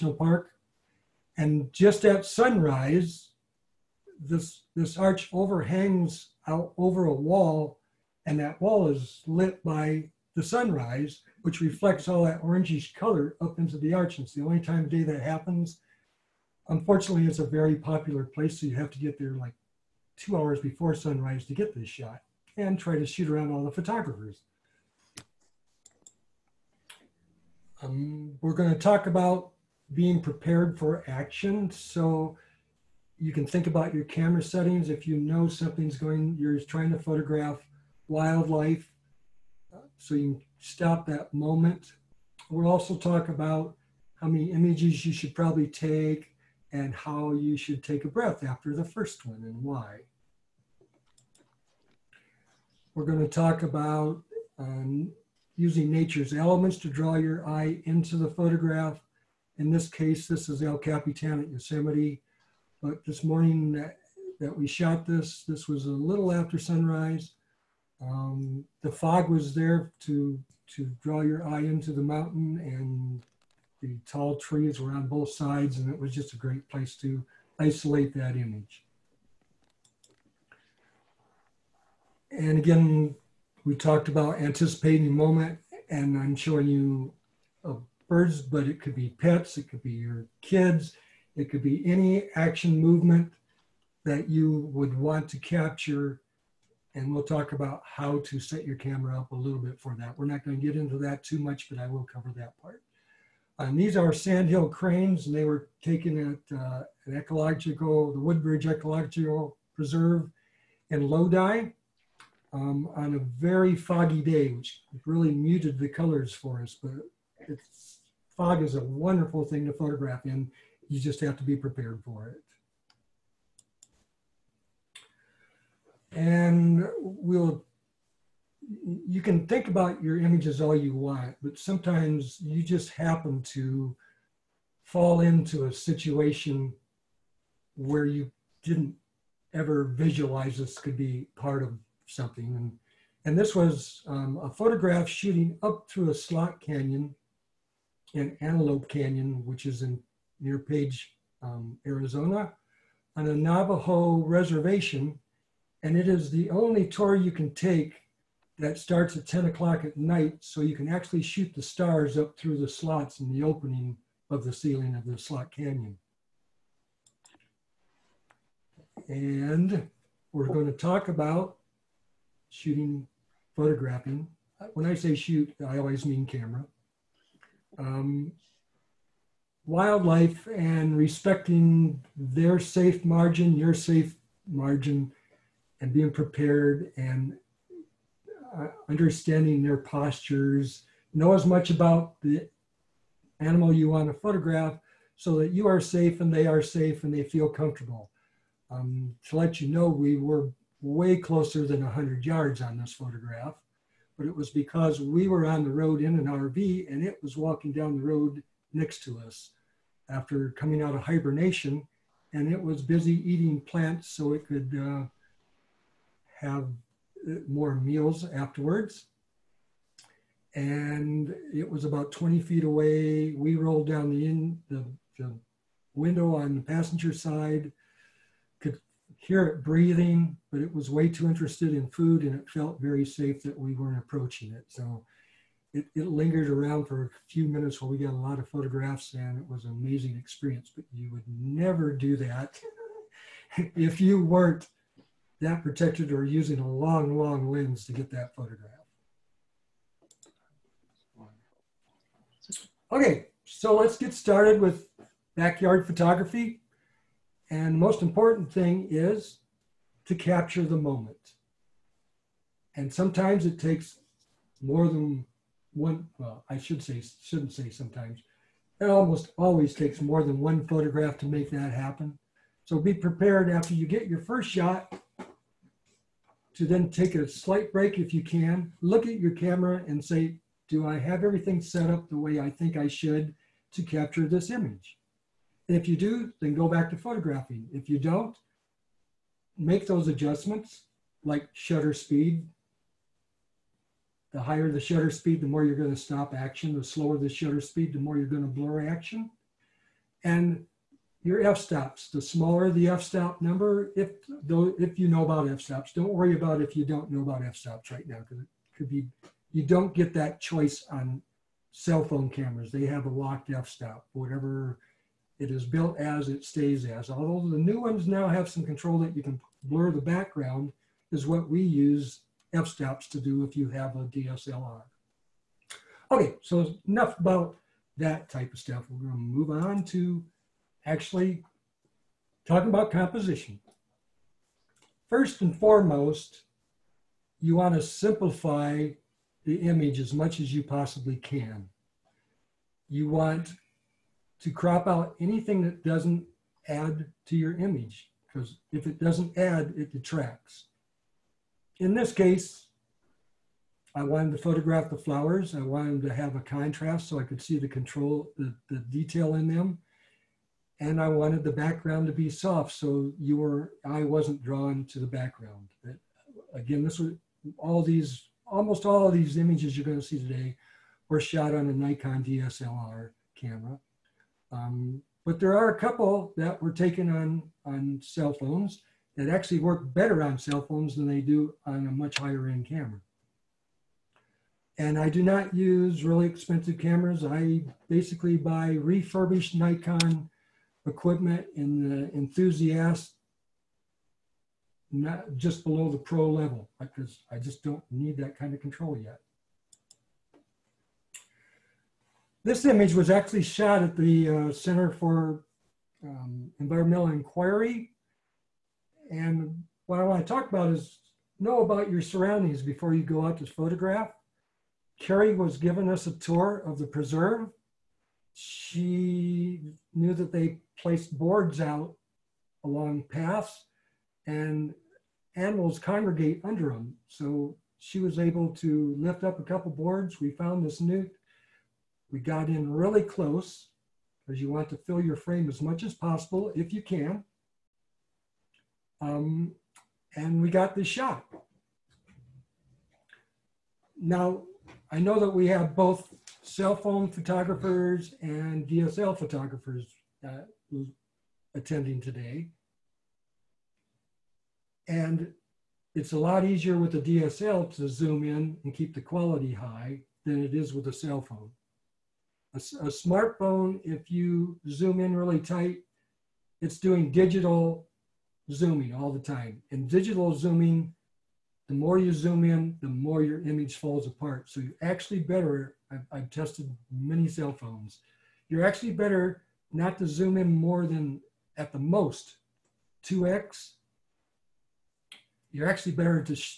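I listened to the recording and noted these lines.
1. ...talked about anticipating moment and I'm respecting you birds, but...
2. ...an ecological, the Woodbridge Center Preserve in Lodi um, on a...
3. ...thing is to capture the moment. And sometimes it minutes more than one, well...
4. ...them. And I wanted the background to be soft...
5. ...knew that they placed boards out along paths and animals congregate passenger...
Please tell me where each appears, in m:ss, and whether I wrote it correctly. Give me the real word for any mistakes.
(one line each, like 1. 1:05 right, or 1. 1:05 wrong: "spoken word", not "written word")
1. 1:23 wrong: "showing", not "respecting"
2. 1:47 wrong: "Ecological", not "Center"
3. 4:18 wrong: "takes", not "minutes"
4. 5:59 right
5. 6:59 wrong: "under", not "passenger".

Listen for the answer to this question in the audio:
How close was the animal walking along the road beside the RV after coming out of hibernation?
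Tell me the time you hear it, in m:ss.
3:42.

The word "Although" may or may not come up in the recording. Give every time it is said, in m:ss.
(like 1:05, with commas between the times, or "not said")
5:17.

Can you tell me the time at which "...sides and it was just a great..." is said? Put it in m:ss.
1:15.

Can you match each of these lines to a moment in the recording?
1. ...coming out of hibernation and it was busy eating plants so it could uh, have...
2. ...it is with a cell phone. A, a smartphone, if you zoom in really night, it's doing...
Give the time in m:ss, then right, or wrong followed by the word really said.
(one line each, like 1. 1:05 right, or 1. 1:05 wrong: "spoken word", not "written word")
1. 3:30 right
2. 7:40 wrong: "tight", not "night".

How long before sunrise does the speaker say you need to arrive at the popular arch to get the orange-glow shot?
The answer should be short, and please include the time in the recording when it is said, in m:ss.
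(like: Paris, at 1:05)
2 hours, at 0:20.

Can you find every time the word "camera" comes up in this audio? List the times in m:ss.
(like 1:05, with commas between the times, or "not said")
0:34, 1:38, 2:56, 4:39, 5:12, 6:13, 6:22, 6:26.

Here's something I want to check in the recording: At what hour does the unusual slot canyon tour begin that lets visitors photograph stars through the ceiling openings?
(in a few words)
10 o'clock at night.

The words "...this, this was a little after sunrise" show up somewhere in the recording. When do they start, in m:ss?
1:05.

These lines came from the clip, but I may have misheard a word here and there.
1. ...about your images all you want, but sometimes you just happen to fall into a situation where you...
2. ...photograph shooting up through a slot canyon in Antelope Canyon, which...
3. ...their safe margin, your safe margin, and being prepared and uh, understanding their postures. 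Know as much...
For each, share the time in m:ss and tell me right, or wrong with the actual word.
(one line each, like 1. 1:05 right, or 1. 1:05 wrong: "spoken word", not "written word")
1. 2:09 right
2. 2:24 right
3. 3:02 right.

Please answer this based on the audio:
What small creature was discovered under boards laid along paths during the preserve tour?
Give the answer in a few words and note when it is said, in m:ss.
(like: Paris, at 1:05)
Newt, at 7:10.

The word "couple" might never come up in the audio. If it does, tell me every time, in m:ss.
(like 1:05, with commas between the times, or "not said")
6:15, 7:09.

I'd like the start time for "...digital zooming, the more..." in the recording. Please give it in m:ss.
7:49.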